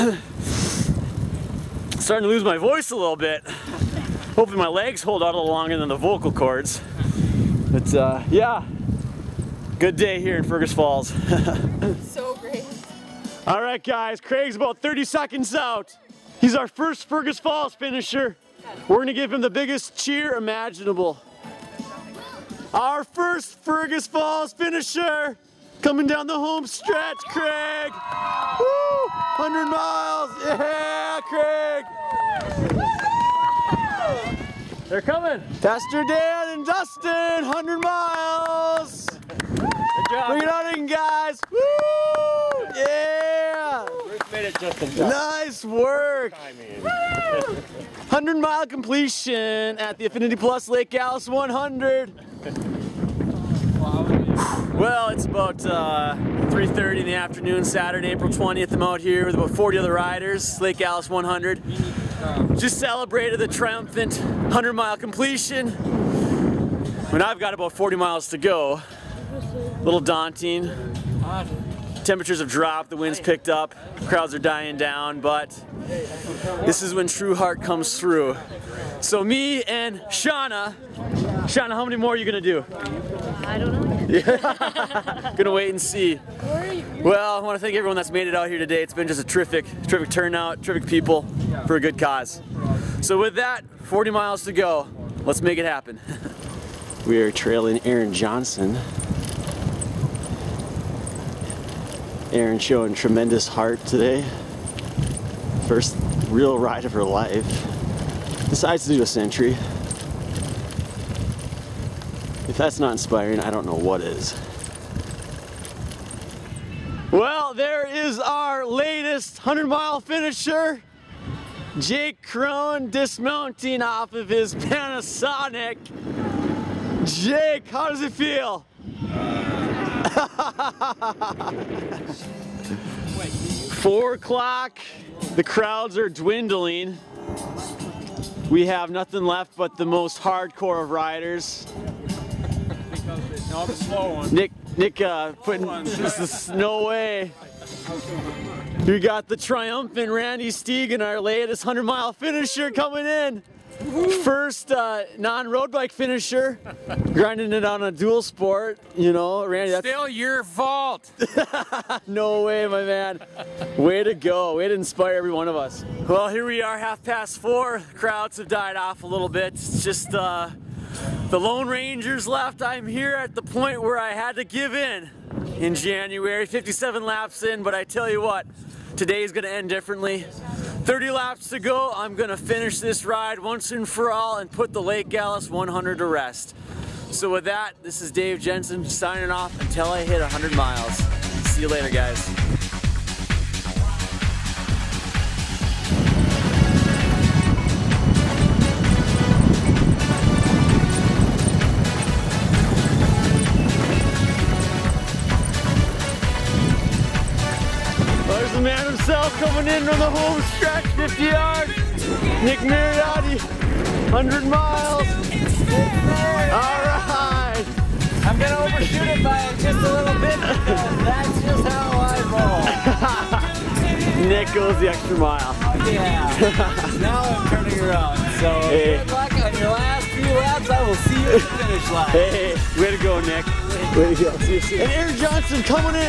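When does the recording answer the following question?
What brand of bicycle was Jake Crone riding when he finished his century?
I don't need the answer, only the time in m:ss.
2:04.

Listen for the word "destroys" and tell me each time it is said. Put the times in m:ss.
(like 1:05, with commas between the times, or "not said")
not said.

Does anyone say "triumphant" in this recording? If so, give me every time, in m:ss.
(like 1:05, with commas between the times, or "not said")
1:03, 2:29.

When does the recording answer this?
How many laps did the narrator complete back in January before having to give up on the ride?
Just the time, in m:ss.
2:56.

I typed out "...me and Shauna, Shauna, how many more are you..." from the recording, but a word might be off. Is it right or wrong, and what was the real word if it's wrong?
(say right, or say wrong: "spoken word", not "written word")
right.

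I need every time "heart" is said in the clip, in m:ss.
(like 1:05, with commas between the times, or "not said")
1:17, 1:43.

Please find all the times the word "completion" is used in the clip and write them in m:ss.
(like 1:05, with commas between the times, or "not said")
0:48, 1:04.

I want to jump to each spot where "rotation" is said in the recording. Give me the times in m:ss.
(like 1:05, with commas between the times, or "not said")
not said.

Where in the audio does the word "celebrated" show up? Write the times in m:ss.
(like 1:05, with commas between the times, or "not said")
1:02.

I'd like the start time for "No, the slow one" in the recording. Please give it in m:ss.
2:23.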